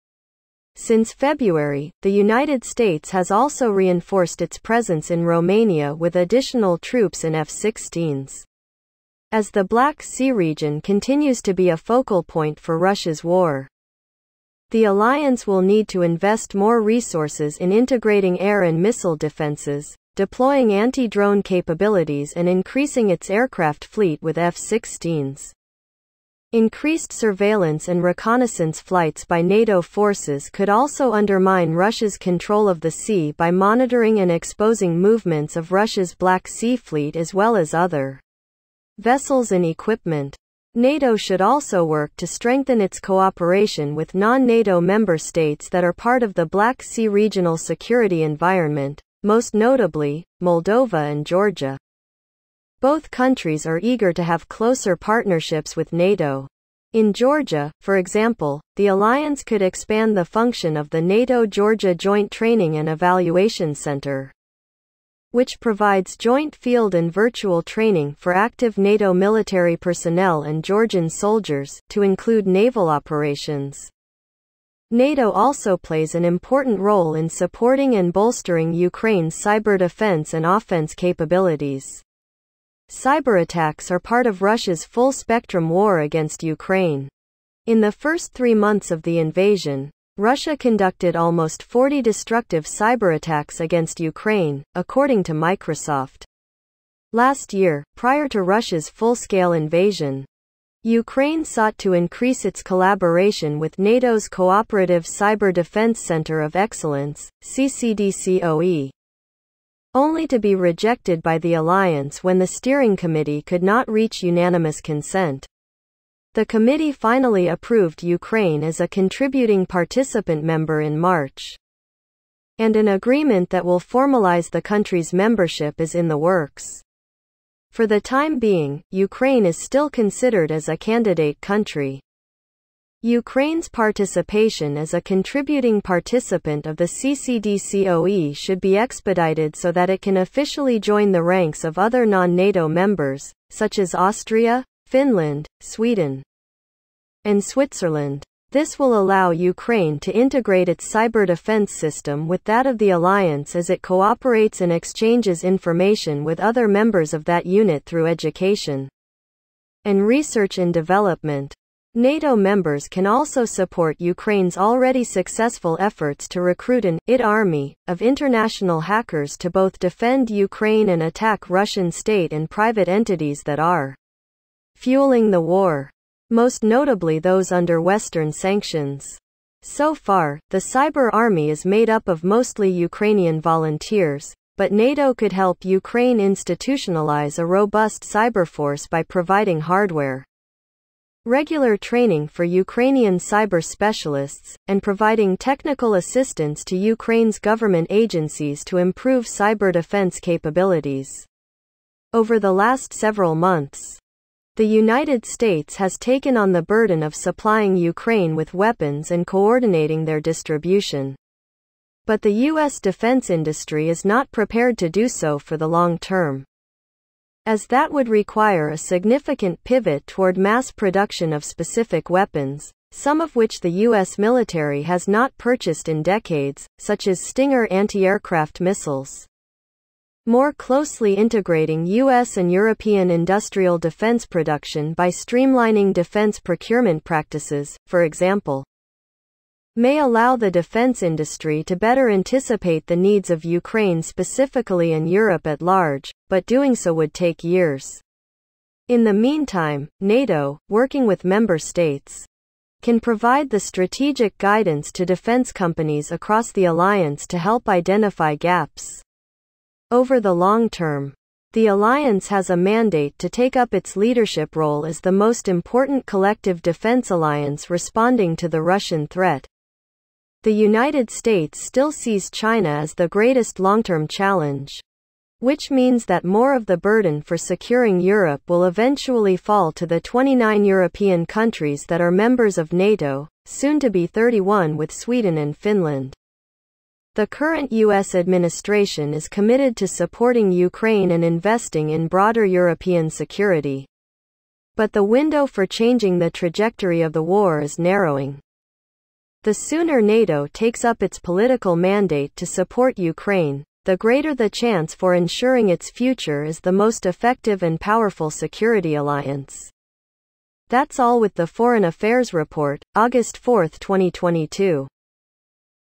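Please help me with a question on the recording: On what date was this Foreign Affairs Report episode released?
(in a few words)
August 4, 2022.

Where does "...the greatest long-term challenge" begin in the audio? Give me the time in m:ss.
4:32.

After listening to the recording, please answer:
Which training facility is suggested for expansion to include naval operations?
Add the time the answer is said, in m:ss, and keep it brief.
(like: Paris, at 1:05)
NATO Georgia Joint Training and Evaluation Center, at 1:01.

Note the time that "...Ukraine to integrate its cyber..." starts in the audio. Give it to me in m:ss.
2:29.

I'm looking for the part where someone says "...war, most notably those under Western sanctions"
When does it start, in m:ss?
2:55.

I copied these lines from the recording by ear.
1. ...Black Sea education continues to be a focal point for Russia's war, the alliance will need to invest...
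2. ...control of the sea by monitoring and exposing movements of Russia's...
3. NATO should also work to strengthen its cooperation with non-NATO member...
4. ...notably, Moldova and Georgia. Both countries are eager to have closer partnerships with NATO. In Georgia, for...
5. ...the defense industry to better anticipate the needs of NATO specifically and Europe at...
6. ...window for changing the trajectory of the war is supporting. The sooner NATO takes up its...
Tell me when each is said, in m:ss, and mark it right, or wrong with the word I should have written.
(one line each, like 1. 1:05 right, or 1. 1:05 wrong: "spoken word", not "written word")
1. 0:09 wrong: "region", not "education"
2. 0:32 right
3. 0:40 right
4. 0:49 right
5. 4:00 wrong: "Ukraine", not "NATO"
6. 4:55 wrong: "narrowing", not "supporting".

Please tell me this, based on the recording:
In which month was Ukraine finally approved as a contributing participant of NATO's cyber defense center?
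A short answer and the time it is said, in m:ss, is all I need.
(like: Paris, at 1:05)
March, at 2:00.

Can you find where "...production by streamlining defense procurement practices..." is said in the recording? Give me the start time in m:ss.
3:54.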